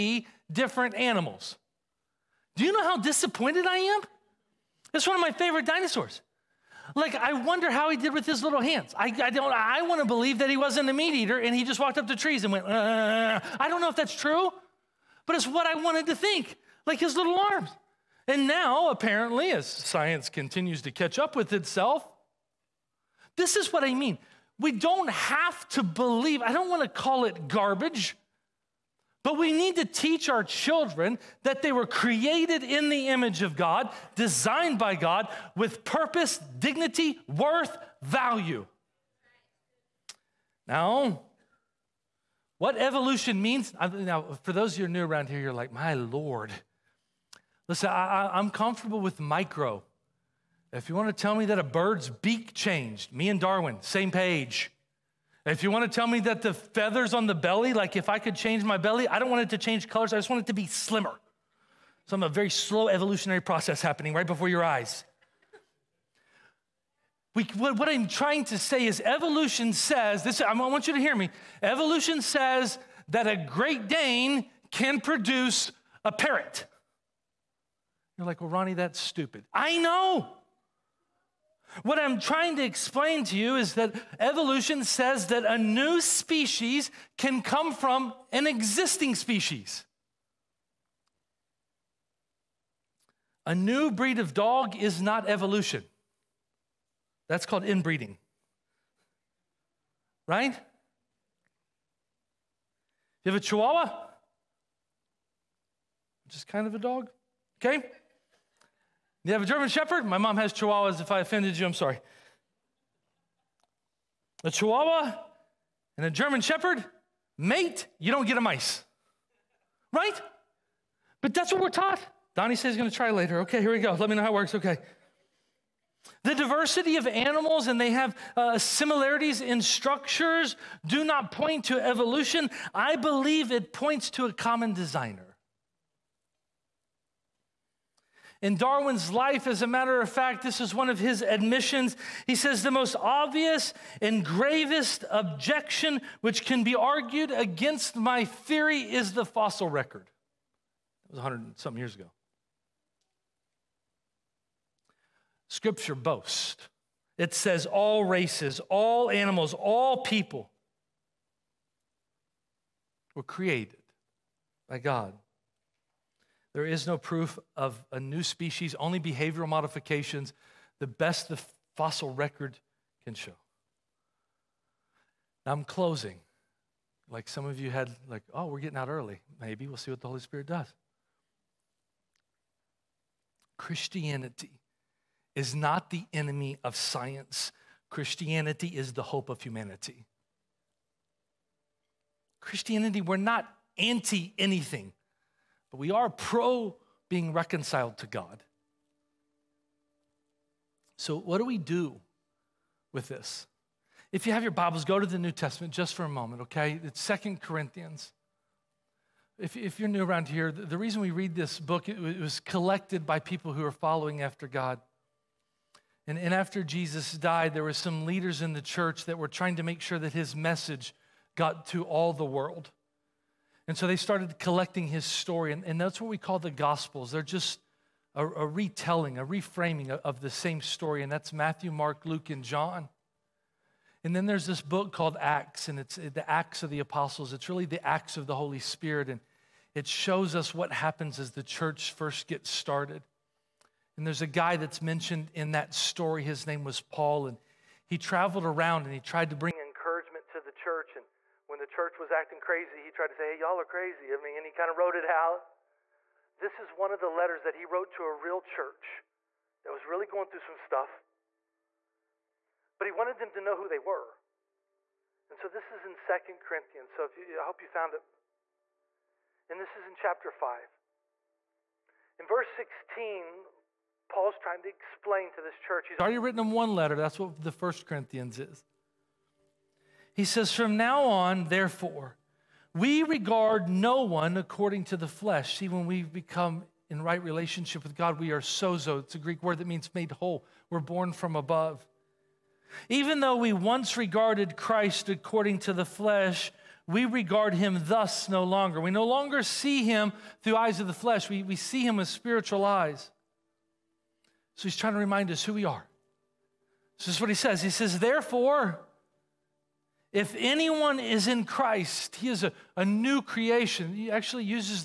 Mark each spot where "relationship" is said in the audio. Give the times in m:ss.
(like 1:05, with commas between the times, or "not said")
4:47.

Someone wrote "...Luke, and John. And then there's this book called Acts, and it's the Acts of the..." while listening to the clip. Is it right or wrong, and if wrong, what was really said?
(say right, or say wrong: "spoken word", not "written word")
right.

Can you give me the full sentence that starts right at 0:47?
Listen, I, am comfortable with micro.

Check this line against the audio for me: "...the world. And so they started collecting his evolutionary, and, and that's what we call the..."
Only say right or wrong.
wrong.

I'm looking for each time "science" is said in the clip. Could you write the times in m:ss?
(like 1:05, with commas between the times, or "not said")
0:19, 3:06.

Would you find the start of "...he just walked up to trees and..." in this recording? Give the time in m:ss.
0:11.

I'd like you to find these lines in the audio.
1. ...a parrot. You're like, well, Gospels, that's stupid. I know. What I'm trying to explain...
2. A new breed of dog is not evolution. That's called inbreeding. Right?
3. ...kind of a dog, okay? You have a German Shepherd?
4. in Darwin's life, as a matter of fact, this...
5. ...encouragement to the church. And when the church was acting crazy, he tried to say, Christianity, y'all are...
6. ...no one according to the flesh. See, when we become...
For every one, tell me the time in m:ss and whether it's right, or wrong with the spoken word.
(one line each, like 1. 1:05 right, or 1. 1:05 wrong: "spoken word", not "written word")
1. 1:16 wrong: "Ronnie", not "Gospels"
2. 1:33 right
3. 1:46 right
4. 2:18 right
5. 4:09 wrong: "Hey", not "Christianity"
6. 4:43 right.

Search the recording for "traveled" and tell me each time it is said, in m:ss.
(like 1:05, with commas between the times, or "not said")
4:07.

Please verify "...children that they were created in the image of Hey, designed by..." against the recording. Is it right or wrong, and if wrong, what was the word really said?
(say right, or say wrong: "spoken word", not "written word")
wrong: "God", not "Hey".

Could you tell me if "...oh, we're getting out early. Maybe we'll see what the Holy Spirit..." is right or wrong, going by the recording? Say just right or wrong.
right.